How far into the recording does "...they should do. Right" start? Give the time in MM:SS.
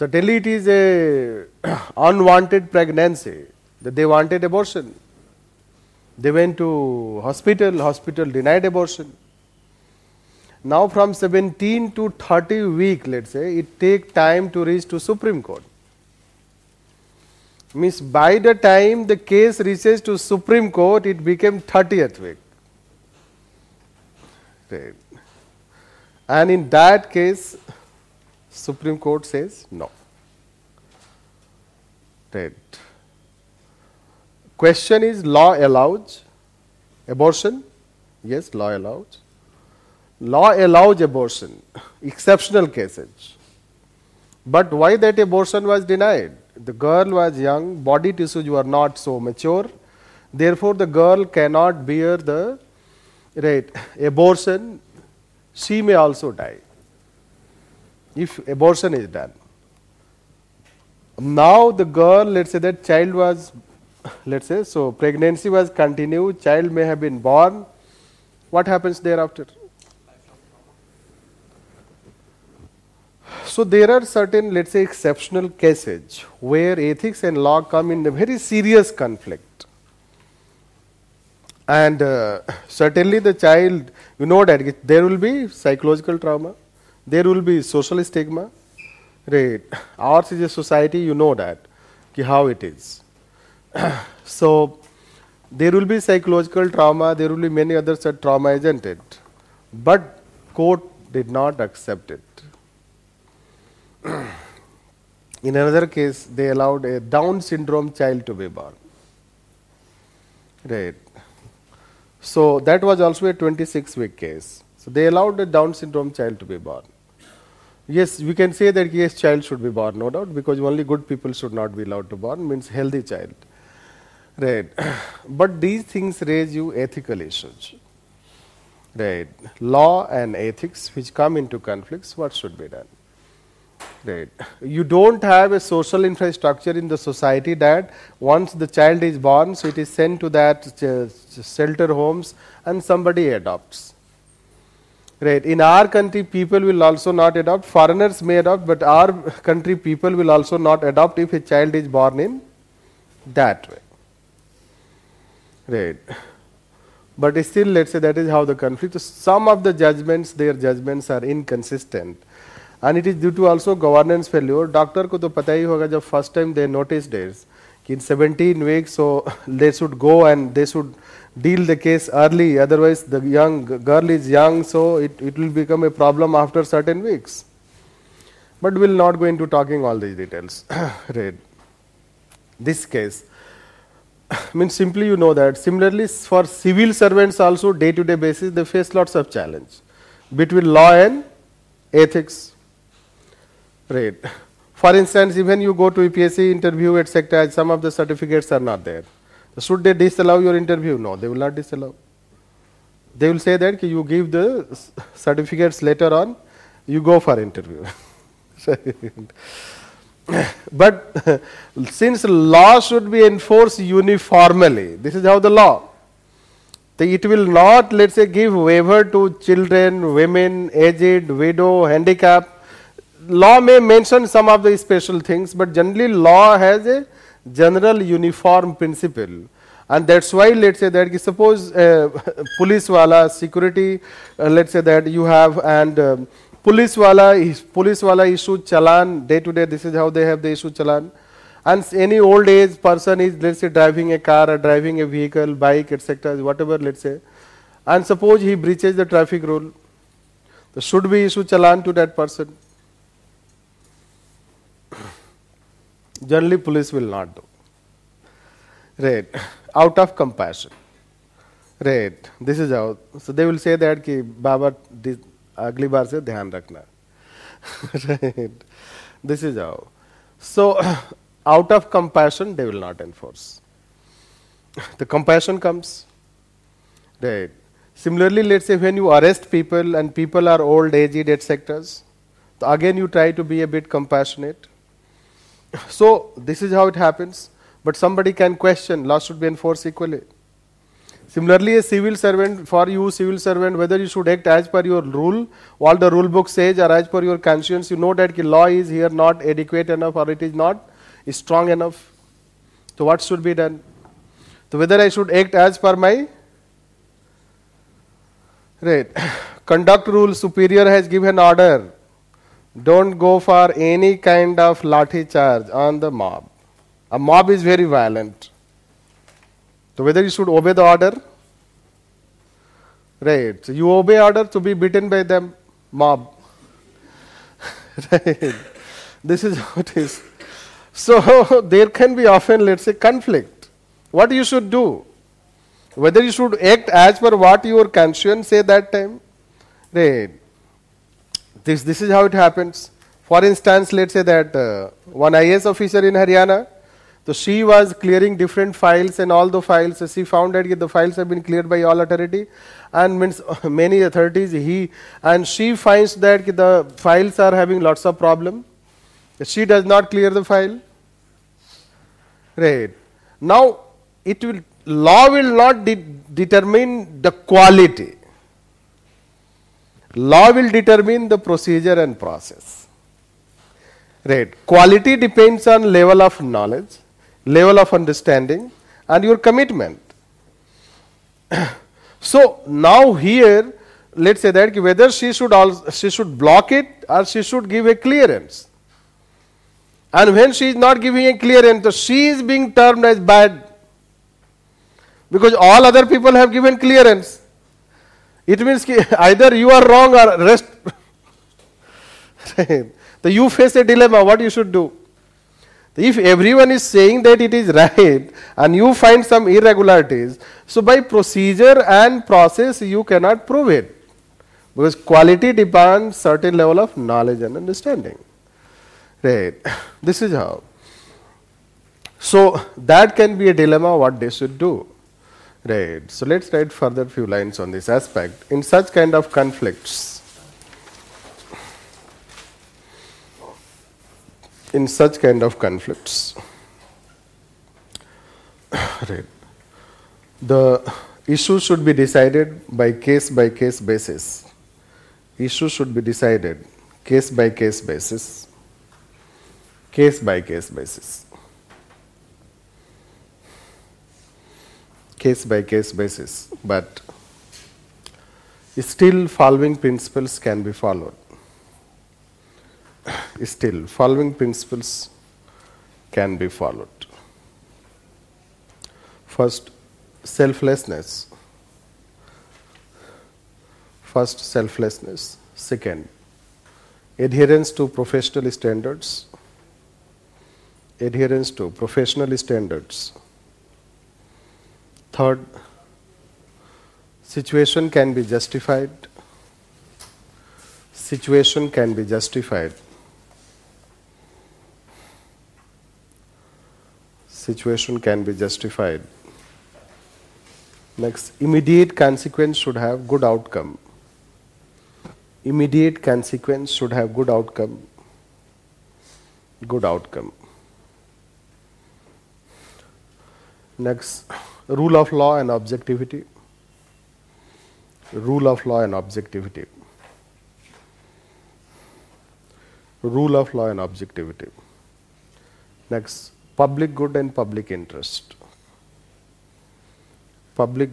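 07:04.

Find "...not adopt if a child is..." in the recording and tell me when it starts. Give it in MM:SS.
02:30.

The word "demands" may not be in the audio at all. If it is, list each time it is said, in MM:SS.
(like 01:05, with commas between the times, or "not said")
06:55.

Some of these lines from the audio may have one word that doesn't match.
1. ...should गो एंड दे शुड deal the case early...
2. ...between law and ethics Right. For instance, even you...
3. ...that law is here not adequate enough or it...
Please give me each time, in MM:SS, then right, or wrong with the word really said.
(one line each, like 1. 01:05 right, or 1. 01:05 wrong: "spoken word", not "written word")
1. 02:49 right
2. 03:10 right
3. 04:58 right.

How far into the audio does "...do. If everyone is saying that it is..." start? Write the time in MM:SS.
06:44.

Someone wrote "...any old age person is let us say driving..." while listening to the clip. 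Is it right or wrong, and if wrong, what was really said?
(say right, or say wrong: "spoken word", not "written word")
right.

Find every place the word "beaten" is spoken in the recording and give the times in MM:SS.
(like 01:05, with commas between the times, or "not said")
05:24.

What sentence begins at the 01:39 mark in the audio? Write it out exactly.
But court did not accept it.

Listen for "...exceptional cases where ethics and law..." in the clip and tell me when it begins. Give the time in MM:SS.
01:14.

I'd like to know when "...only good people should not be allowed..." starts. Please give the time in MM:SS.
02:00.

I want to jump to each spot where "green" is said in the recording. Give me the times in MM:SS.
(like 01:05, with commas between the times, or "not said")
not said.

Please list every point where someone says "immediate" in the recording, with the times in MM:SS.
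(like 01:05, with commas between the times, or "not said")
08:21, 08:25.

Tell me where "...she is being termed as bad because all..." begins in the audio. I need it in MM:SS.
06:31.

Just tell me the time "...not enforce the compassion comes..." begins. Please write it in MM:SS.
04:32.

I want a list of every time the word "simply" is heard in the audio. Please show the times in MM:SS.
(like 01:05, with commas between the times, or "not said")
03:04.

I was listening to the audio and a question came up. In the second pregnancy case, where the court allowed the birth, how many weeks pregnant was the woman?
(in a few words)
26.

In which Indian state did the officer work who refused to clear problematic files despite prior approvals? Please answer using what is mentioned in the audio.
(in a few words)
Haryana.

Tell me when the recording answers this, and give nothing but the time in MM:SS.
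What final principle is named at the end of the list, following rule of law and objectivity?
08:46.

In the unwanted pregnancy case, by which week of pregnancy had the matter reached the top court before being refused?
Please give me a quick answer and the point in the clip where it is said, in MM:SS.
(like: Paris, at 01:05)
30th week, at 00:21.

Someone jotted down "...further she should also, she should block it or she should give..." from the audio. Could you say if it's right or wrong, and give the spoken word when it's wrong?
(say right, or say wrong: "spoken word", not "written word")
wrong: "whether", not "further".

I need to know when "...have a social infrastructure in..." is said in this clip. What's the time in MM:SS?
02:15.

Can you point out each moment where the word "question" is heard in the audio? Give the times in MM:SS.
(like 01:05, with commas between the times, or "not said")
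00:34, 04:48.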